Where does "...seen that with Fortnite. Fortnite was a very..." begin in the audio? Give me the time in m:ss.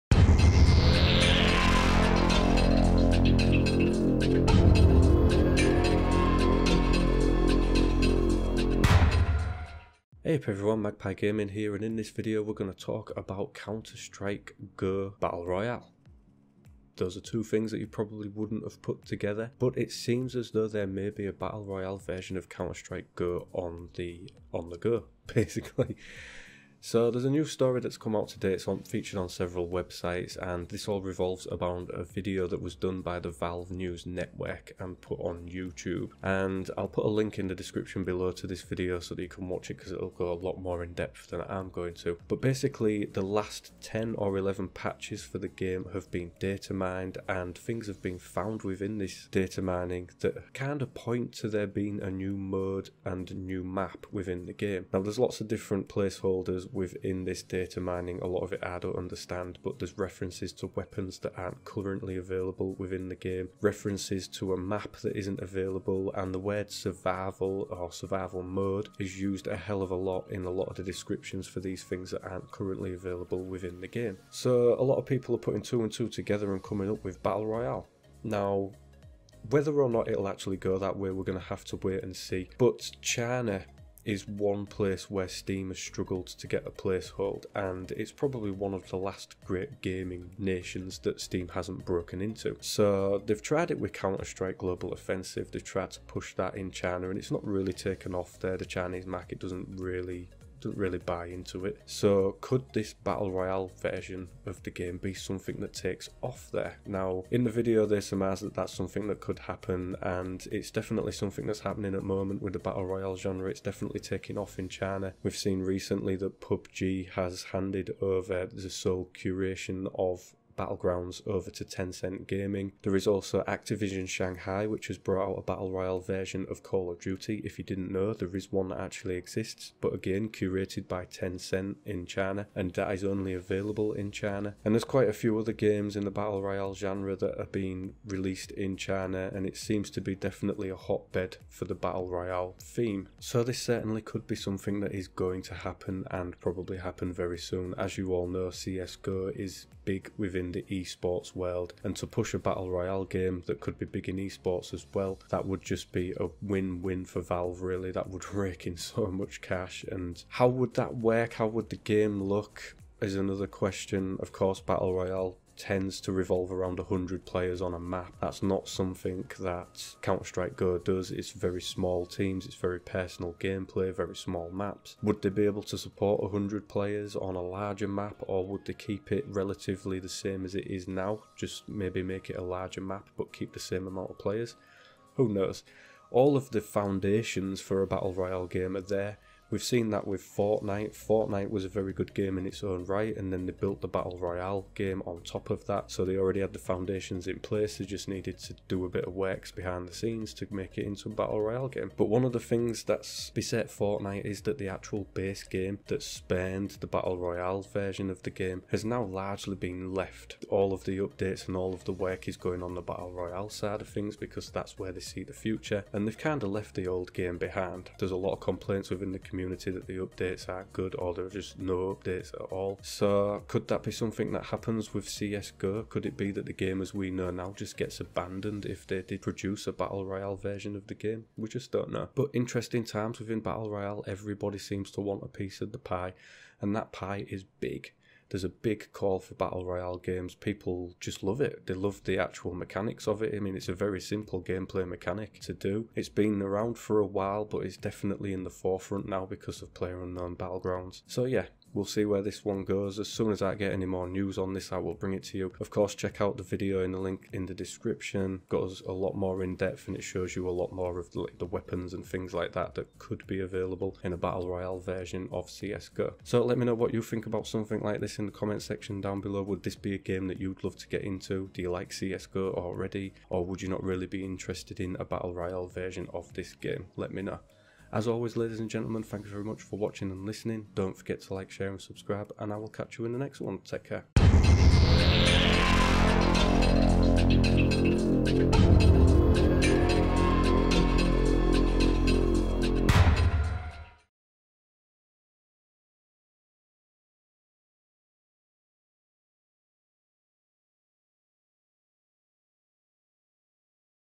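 3:09.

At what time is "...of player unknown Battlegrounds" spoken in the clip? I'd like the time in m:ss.
4:09.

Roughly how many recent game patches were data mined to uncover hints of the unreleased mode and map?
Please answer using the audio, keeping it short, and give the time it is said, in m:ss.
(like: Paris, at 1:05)
10 or 11, at 0:43.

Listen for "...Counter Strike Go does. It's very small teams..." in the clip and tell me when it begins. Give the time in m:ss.
2:50.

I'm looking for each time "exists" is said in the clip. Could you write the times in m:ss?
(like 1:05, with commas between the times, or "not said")
2:09.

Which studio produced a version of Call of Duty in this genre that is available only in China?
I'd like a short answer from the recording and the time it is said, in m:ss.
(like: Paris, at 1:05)
Activision Shanghai, at 2:03.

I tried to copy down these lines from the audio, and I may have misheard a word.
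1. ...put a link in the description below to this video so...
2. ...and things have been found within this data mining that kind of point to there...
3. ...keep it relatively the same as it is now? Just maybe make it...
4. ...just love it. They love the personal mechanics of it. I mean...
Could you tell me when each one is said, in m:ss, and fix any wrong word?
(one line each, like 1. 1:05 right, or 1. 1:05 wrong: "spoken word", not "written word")
1. 0:36 right
2. 0:47 right
3. 2:58 right
4. 4:01 wrong: "actual", not "personal".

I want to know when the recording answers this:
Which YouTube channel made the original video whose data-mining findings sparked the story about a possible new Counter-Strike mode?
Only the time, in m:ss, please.
0:33.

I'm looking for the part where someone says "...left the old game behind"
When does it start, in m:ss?
3:36.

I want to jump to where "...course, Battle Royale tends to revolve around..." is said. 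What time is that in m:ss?
2:44.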